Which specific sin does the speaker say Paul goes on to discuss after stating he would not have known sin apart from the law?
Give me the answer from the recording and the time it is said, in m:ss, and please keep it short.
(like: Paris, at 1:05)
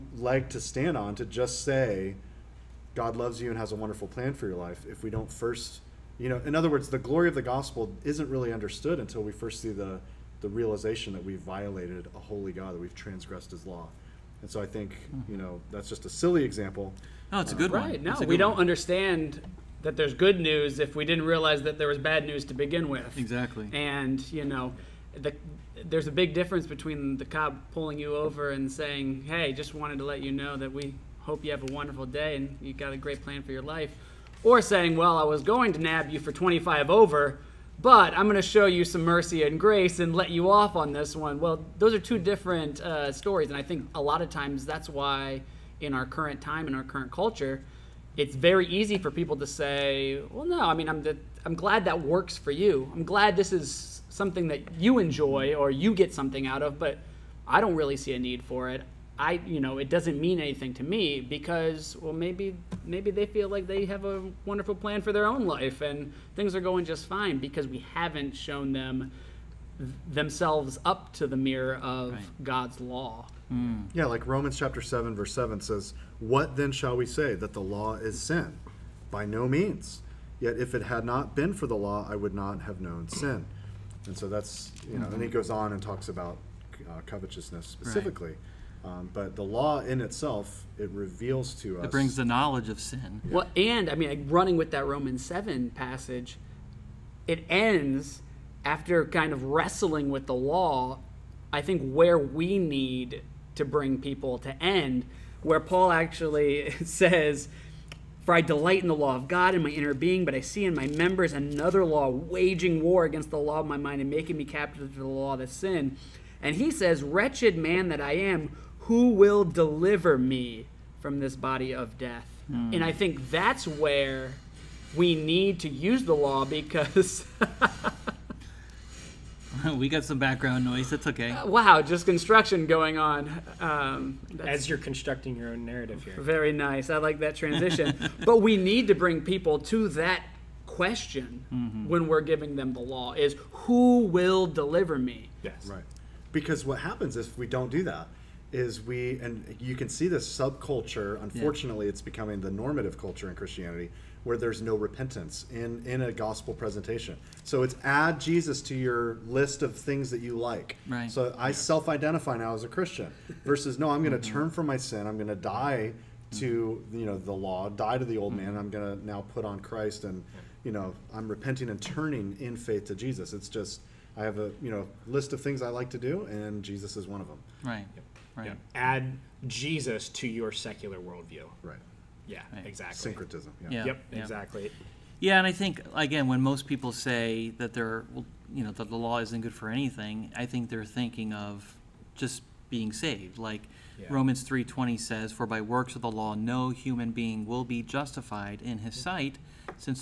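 Covetousness, at 1:27.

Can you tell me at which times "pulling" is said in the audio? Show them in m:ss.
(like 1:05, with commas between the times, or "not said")
0:27.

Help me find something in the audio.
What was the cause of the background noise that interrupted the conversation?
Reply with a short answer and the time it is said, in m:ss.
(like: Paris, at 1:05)
Construction, at 2:12.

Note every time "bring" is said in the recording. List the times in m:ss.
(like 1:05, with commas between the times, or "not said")
1:31, 1:43, 2:18.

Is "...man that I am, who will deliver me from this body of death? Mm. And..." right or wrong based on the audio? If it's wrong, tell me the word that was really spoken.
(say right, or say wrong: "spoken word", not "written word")
right.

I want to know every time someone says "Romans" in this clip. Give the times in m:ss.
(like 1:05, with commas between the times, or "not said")
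1:14, 1:34, 3:14.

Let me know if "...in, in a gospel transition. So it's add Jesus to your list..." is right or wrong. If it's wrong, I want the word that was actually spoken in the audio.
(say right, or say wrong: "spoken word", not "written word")
wrong: "presentation", not "transition".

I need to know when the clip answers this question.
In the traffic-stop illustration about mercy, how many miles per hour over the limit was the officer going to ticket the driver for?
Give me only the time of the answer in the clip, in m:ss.
0:36.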